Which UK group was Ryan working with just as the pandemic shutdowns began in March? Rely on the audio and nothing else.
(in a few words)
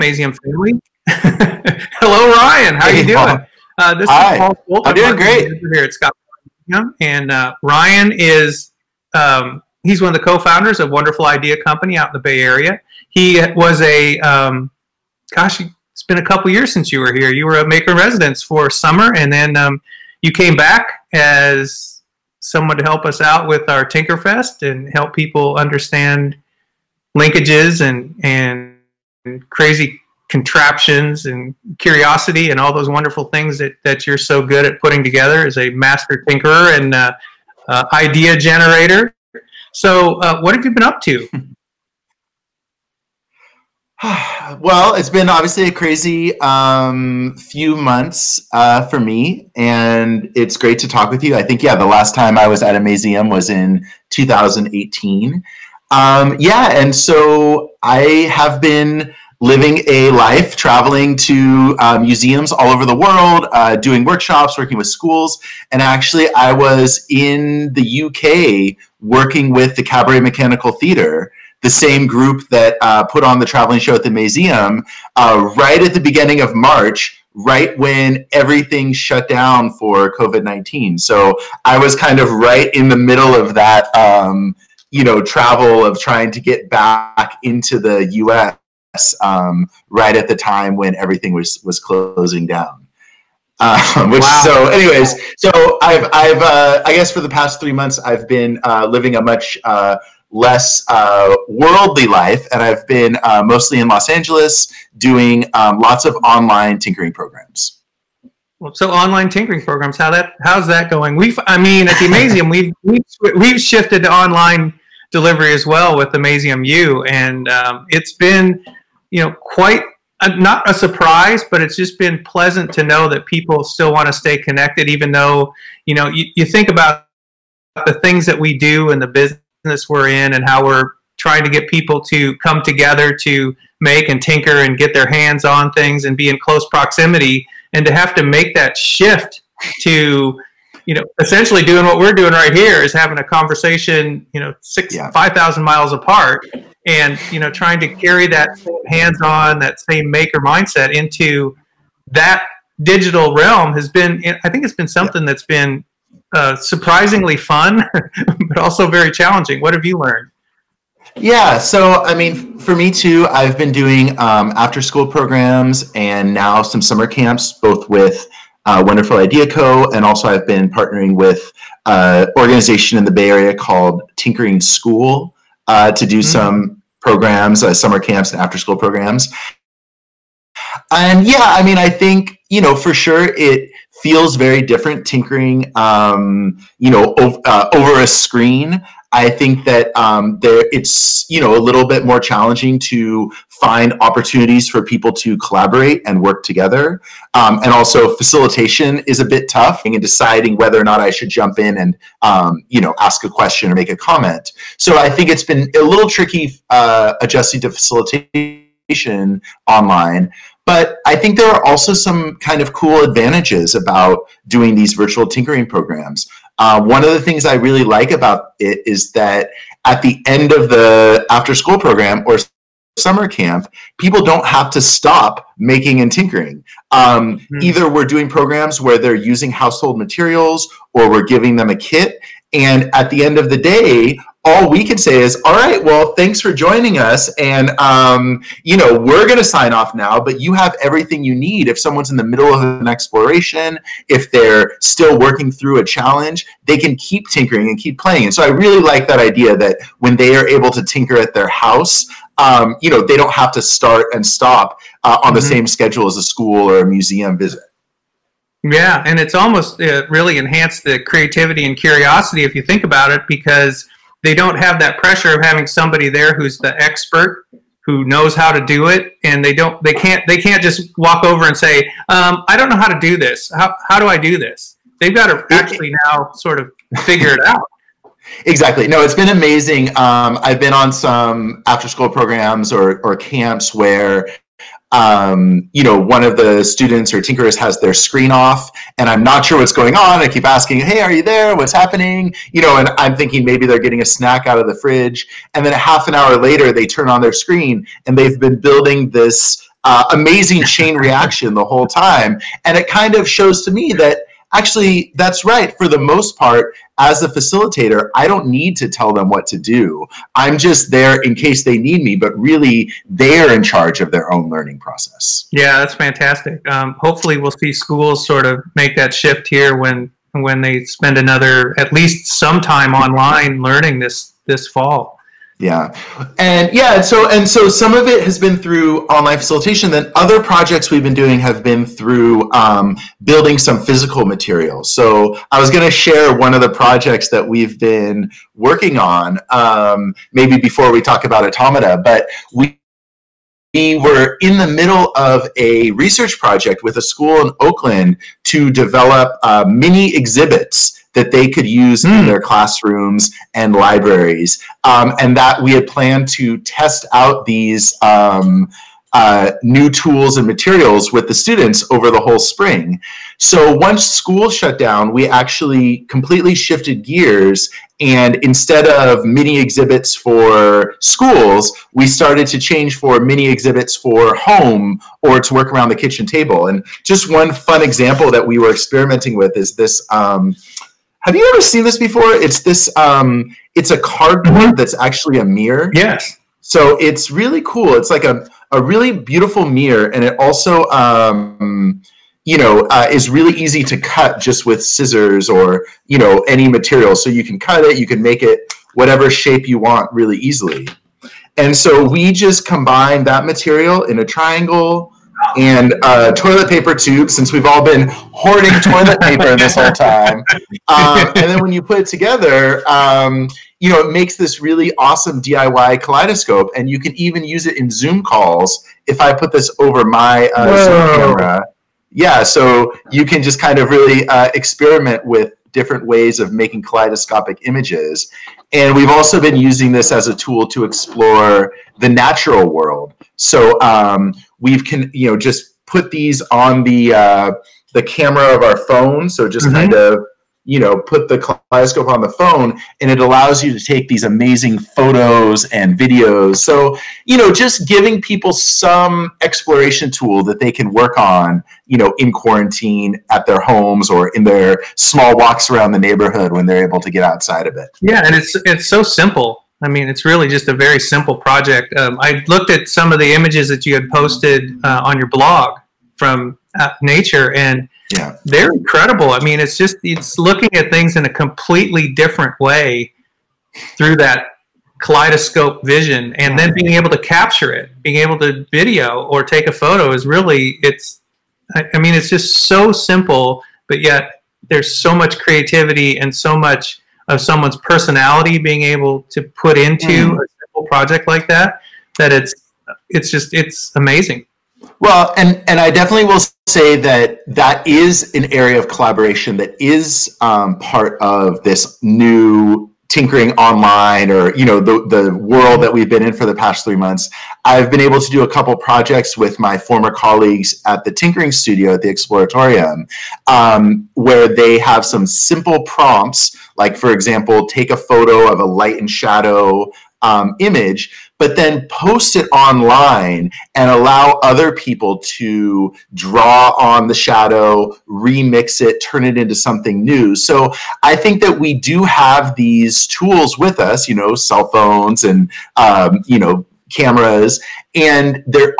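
Cabaret Mechanical Theatre.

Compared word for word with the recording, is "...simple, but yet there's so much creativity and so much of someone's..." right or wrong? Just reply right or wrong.
right.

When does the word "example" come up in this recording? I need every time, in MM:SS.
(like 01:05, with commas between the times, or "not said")
06:17, 08:37.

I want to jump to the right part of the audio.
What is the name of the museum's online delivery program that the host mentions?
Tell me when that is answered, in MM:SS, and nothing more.
01:56.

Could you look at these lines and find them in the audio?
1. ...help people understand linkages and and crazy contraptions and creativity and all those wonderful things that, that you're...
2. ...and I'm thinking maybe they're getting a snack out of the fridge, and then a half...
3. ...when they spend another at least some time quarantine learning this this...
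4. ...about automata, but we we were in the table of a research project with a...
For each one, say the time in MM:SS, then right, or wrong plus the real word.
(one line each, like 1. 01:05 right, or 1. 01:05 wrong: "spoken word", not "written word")
1. 00:24 wrong: "curiosity", not "creativity"
2. 04:52 right
3. 05:20 wrong: "online", not "quarantine"
4. 05:41 wrong: "middle", not "table".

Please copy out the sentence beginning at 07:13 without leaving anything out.
So um, We've can you know just put these on the uh, the camera of our phone, so just mm-hmm.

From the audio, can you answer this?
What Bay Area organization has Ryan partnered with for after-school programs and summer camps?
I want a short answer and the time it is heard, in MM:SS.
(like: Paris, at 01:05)
Tinkering School, at 02:54.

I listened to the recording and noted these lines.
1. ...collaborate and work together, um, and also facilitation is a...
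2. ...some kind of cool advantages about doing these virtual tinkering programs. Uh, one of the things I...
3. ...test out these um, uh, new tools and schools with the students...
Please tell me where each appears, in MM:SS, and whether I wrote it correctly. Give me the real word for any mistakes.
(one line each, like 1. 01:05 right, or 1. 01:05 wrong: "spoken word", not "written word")
1. 03:15 right
2. 03:31 right
3. 05:56 wrong: "materials", not "schools".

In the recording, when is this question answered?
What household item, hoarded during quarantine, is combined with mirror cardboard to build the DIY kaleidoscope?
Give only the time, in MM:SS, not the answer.
06:46.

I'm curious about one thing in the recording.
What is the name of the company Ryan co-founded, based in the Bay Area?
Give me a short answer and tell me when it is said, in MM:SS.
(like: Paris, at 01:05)
Wonderful Idea Company, at 00:10.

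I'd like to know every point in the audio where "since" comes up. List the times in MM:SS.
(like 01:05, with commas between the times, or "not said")
00:16, 06:47.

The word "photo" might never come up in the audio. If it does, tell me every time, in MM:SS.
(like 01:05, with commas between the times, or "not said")
07:24, 07:59, 08:37.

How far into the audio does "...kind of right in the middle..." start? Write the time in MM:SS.
01:21.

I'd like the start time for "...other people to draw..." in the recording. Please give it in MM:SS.
08:44.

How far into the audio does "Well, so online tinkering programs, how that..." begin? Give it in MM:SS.
01:48.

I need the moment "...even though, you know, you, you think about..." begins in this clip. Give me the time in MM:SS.
02:04.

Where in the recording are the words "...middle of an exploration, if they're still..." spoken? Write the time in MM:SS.
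04:02.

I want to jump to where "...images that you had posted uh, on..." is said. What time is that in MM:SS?
07:43.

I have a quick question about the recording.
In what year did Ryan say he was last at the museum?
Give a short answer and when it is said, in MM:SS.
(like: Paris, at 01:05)
2018, at 00:54.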